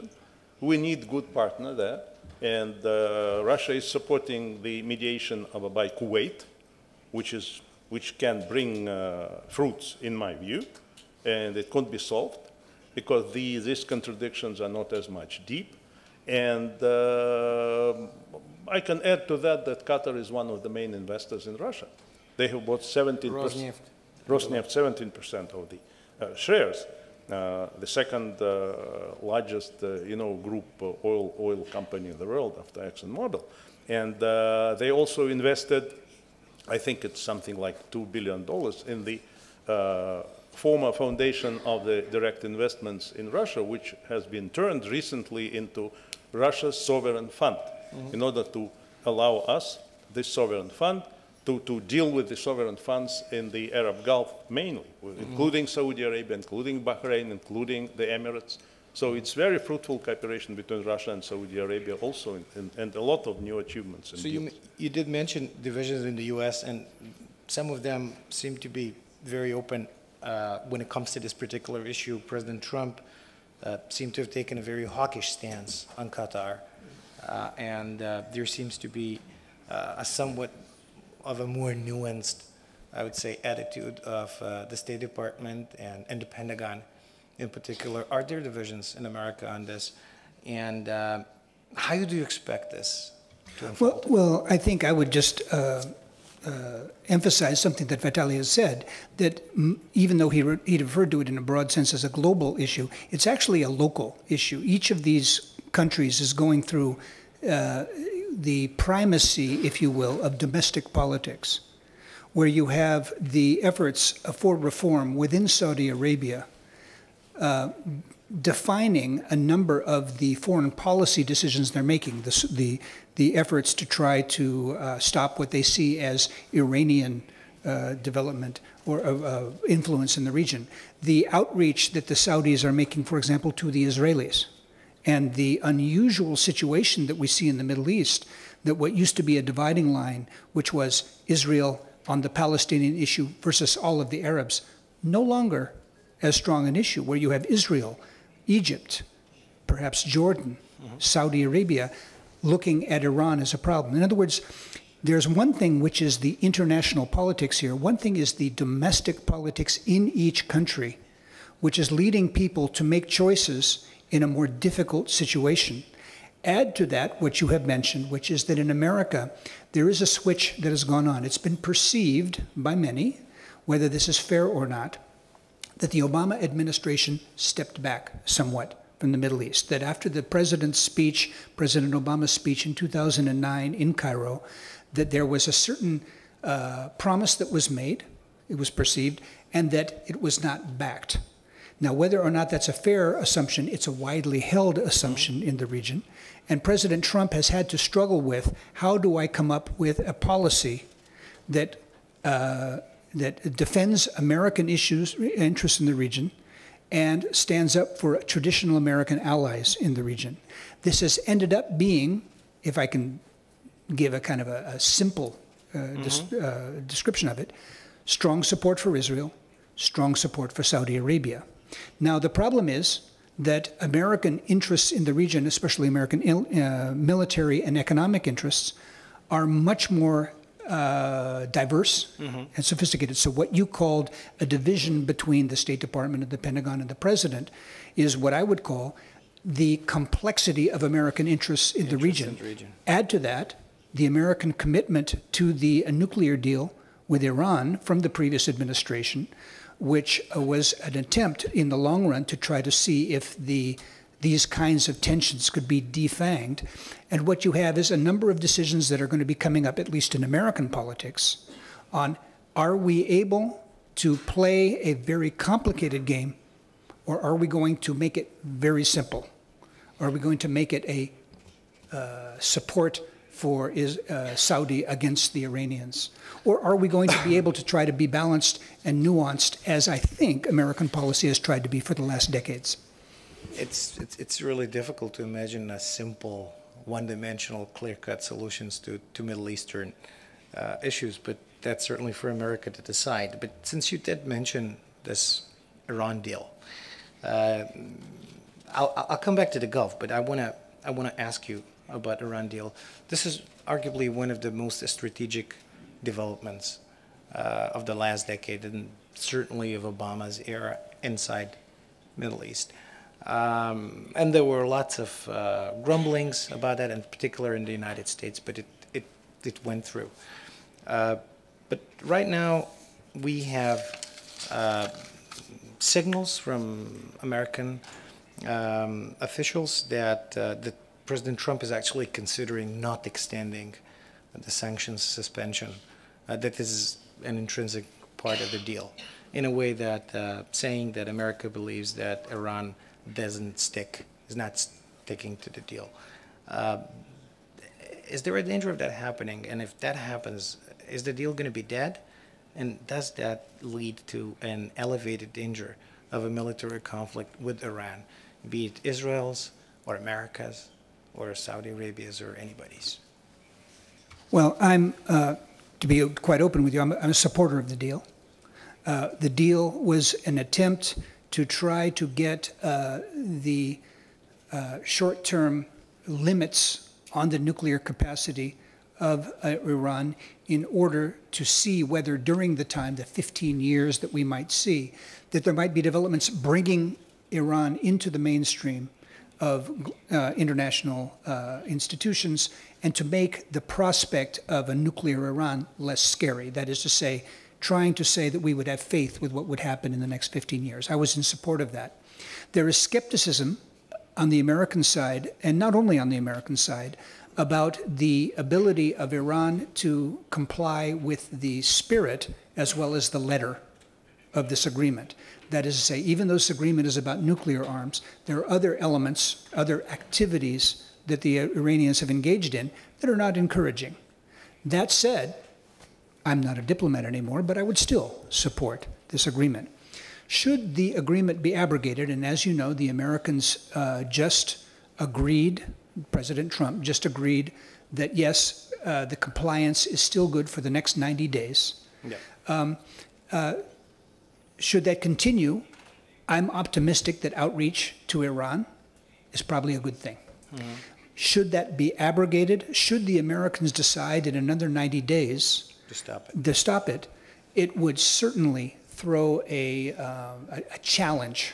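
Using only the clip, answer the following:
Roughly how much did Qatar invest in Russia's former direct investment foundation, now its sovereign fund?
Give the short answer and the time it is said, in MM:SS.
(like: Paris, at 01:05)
2 billion dollars, at 00:37.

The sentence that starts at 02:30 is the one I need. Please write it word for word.
Saudi Arabia, looking at Iran as a problem.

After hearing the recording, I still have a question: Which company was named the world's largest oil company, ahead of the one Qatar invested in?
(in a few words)
ExxonMobil.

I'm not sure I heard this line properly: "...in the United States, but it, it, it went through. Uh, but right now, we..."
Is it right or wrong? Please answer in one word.
right.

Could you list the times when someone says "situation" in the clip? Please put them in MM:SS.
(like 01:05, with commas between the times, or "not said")
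02:16, 02:45.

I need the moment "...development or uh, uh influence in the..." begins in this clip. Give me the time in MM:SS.
02:07.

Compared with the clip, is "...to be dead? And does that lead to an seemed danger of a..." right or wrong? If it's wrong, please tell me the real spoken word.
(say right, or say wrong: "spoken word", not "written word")
wrong: "elevated", not "seemed".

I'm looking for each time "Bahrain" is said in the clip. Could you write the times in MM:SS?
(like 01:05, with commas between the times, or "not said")
00:56.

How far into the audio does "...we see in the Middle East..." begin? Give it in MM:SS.
02:17.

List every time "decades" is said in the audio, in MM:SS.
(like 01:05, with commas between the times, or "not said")
04:42, 05:08.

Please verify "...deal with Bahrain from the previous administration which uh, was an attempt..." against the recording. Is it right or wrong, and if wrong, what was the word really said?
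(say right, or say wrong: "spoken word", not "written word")
wrong: "Iran", not "Bahrain".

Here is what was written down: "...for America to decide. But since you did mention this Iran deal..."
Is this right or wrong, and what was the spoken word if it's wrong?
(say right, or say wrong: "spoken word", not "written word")
right.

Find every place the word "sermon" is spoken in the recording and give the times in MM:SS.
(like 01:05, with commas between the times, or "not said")
not said.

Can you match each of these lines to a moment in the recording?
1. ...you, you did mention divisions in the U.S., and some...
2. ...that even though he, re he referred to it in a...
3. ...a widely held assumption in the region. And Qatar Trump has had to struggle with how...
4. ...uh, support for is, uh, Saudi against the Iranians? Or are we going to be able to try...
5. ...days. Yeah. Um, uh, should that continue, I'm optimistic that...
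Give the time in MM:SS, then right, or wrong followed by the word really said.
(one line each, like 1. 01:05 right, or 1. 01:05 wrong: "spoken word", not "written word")
1. 01:04 right
2. 01:39 right
3. 03:13 wrong: "President", not "Qatar"
4. 04:31 right
5. 07:21 right.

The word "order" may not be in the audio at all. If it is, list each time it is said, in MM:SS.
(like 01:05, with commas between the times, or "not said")
00:48, 06:20.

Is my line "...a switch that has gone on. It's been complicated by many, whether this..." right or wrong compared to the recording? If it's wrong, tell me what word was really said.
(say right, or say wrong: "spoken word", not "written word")
wrong: "perceived", not "complicated".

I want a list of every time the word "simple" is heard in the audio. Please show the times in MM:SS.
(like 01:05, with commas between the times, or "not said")
03:34, 04:28, 04:45.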